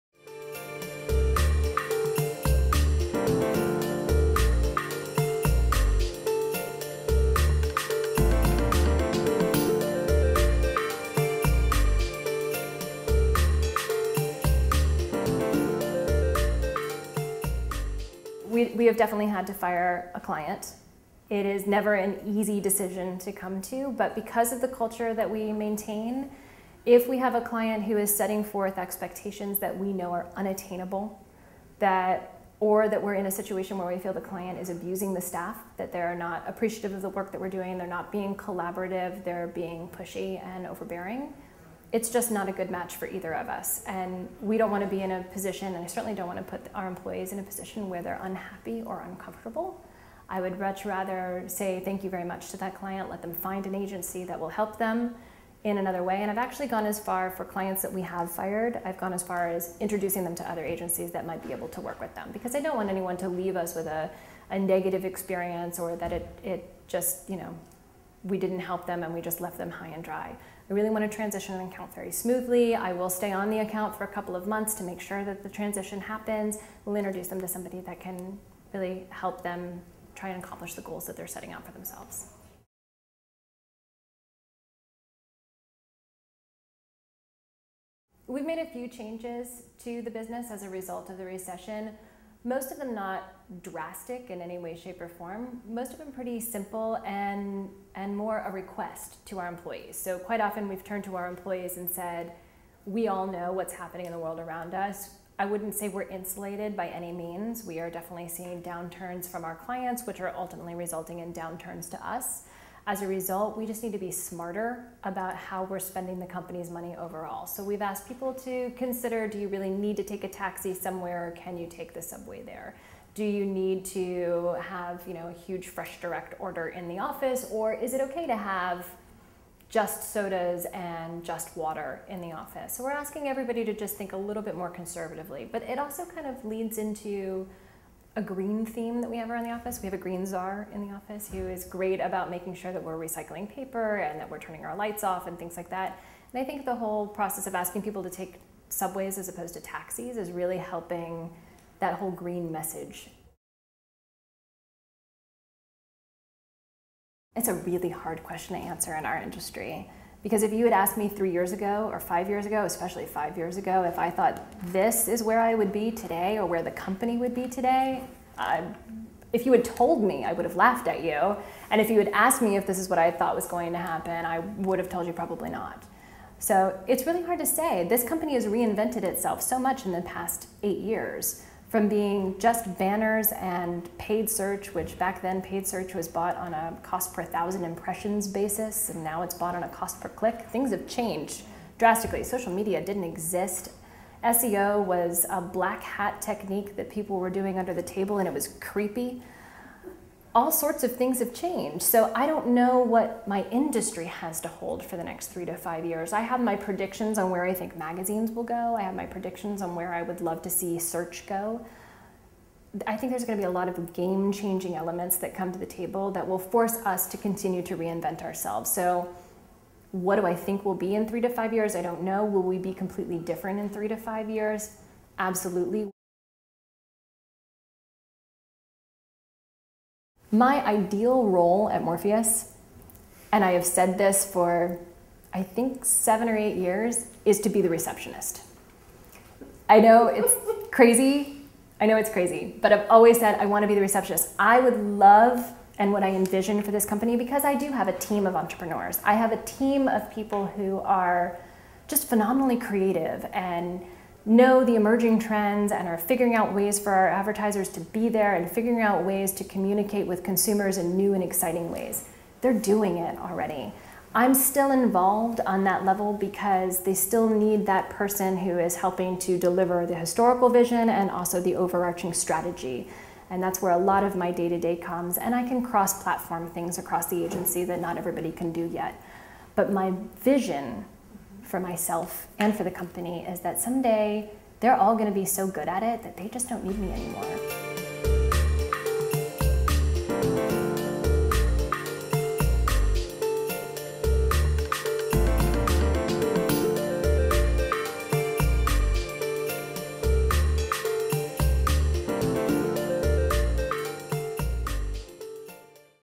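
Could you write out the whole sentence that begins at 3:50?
My ideal role at Morpheus, and I have said this for I think seven or eight years, is to be the receptionist.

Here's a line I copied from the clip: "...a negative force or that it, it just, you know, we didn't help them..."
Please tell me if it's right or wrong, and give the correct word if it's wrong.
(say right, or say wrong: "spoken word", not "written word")
wrong: "experience", not "force".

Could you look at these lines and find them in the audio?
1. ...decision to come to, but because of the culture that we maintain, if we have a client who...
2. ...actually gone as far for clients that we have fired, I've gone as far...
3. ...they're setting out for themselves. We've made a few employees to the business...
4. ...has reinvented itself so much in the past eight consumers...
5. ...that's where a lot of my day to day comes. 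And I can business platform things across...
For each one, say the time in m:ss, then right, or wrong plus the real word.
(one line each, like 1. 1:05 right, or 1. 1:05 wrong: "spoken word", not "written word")
1. 0:22 right
2. 0:56 right
3. 1:21 wrong: "changes", not "employees"
4. 2:58 wrong: "years", not "consumers"
5. 4:33 wrong: "cross", not "business".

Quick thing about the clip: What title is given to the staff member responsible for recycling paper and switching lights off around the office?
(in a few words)
green czar.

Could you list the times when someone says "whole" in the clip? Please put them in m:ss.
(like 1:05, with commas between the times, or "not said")
2:26, 2:31.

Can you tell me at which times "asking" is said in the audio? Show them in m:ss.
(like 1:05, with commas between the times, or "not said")
2:12, 2:27.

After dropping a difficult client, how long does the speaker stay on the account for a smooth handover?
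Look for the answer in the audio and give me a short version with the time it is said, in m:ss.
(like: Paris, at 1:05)
a couple of months, at 1:14.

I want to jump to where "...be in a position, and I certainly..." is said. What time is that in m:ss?
0:44.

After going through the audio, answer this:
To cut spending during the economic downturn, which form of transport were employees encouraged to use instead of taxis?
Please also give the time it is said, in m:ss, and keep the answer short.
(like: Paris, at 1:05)
subway, at 2:02.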